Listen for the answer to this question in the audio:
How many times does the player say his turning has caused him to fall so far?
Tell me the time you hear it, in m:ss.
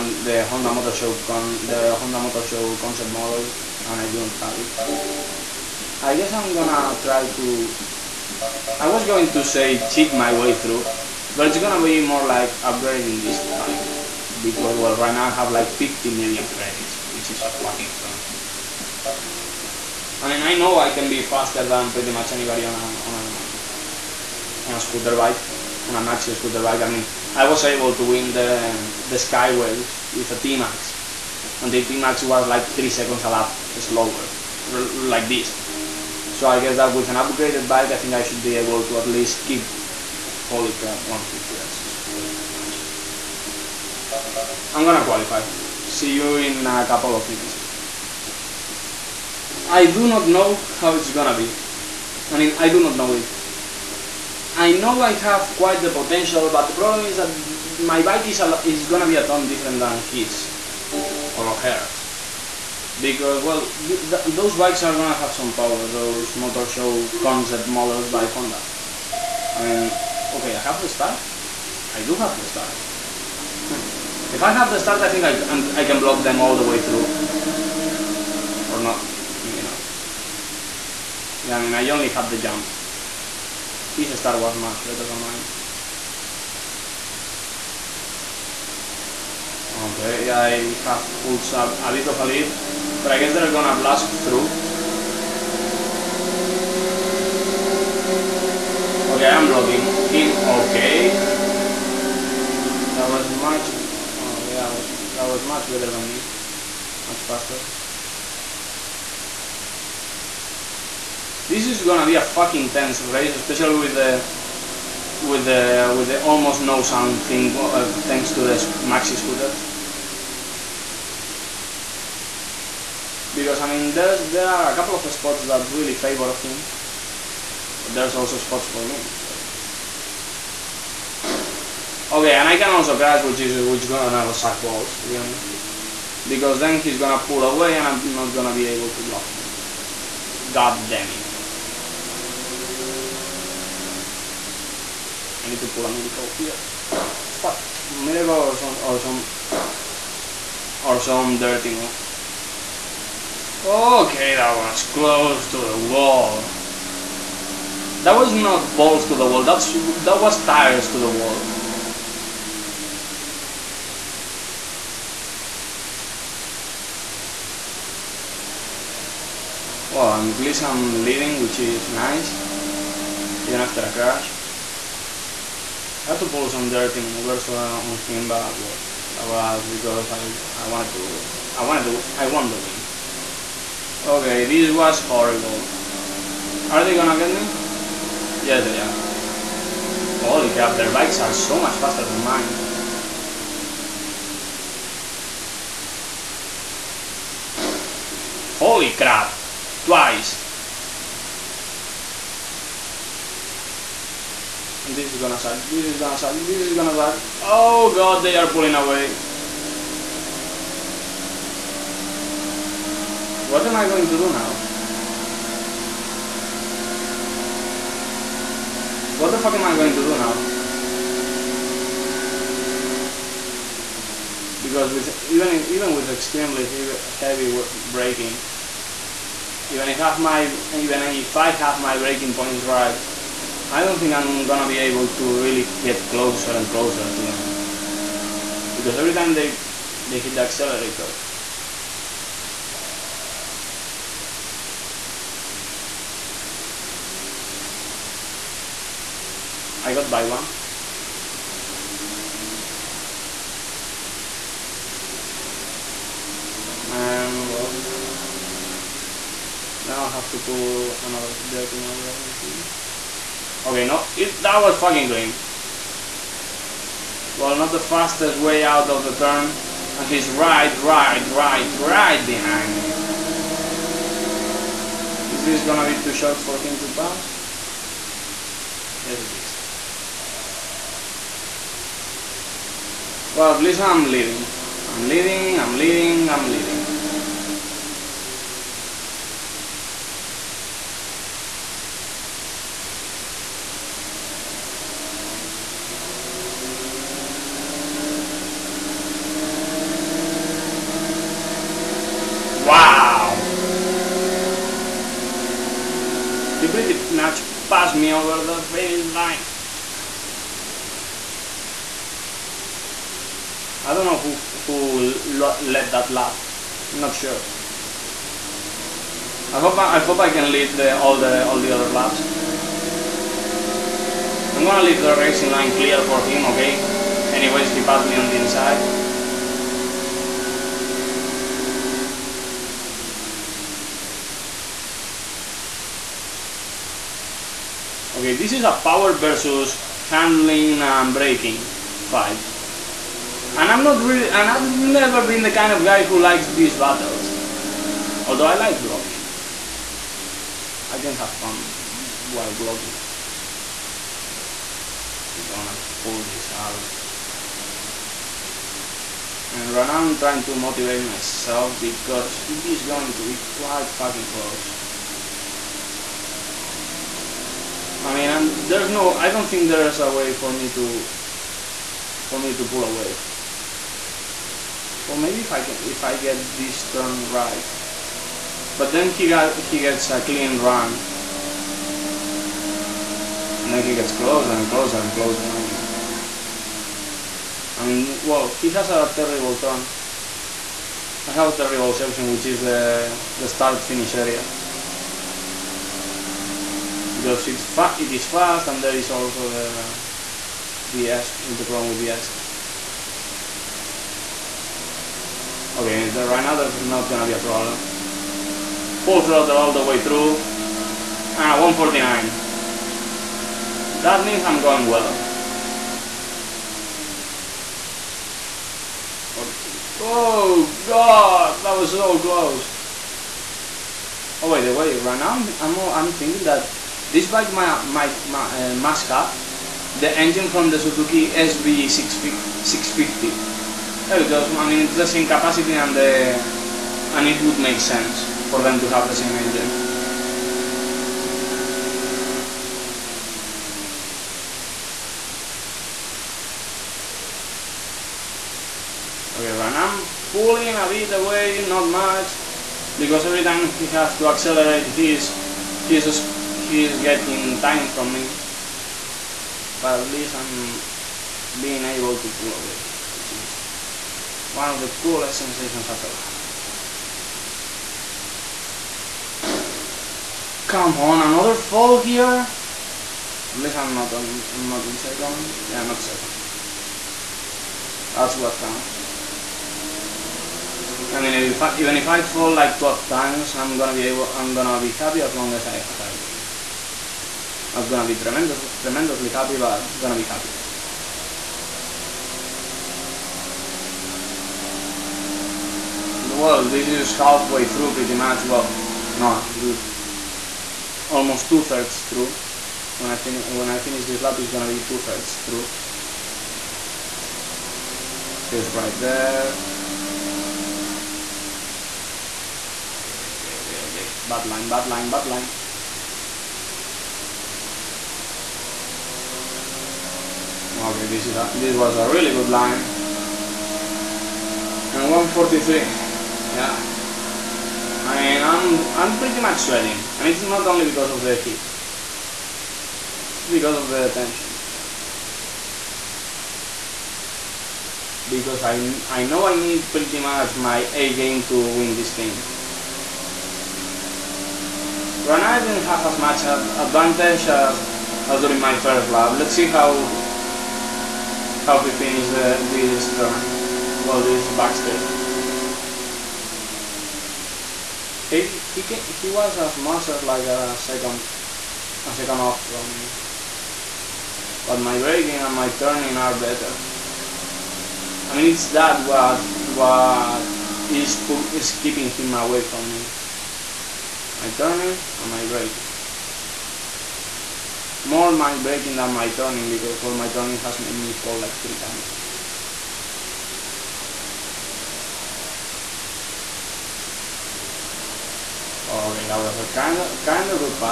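9:41.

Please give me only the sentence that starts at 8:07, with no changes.
I was gonna be tremendously, tremendously happy, but gonna be happy.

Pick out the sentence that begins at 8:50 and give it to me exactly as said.
And it's not only because of the heat.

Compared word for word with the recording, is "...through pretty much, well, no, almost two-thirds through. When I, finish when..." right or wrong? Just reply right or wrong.
right.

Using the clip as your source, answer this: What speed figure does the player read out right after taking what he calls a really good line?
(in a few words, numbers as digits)
143.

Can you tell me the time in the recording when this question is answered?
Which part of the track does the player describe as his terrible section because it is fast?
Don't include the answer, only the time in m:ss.
6:33.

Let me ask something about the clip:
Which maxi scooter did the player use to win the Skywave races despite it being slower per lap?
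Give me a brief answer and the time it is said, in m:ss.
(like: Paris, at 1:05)
T-Max, at 0:30.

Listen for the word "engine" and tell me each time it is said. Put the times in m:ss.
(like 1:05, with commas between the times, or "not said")
7:10, 7:19.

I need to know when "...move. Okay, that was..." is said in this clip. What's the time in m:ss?
2:31.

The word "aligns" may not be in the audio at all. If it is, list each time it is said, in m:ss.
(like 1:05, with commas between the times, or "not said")
not said.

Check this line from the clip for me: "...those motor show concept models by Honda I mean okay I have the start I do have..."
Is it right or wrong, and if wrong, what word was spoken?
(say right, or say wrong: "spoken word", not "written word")
right.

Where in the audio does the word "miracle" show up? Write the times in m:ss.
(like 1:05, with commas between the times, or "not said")
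2:27.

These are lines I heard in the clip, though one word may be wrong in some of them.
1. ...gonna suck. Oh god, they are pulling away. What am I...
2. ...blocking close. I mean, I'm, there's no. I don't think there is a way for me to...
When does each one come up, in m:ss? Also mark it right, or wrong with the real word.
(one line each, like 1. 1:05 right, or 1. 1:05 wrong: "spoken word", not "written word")
1. 3:26 right
2. 6:03 wrong: "fucking", not "blocking".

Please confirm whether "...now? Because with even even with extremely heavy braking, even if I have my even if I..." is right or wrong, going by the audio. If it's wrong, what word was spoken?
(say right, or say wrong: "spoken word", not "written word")
right.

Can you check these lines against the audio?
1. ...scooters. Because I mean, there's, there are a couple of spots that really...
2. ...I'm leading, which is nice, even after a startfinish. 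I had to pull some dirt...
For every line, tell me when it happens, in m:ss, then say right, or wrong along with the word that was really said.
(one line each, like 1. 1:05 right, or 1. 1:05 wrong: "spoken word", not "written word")
1. 1:59 right
2. 2:50 wrong: "crash", not "startfinish".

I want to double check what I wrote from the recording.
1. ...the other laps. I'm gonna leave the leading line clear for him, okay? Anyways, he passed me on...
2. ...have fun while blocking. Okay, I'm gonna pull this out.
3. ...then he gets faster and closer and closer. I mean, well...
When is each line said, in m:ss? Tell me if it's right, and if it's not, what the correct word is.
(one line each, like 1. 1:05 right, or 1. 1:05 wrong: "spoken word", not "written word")
1. 5:21 wrong: "racing", not "leading"
2. 5:51 right
3. 6:23 wrong: "closer", not "faster".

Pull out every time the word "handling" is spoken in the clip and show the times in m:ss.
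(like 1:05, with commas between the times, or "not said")
5:40.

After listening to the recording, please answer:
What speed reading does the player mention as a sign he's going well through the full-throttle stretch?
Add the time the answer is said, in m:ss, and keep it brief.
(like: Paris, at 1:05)
149, at 6:51.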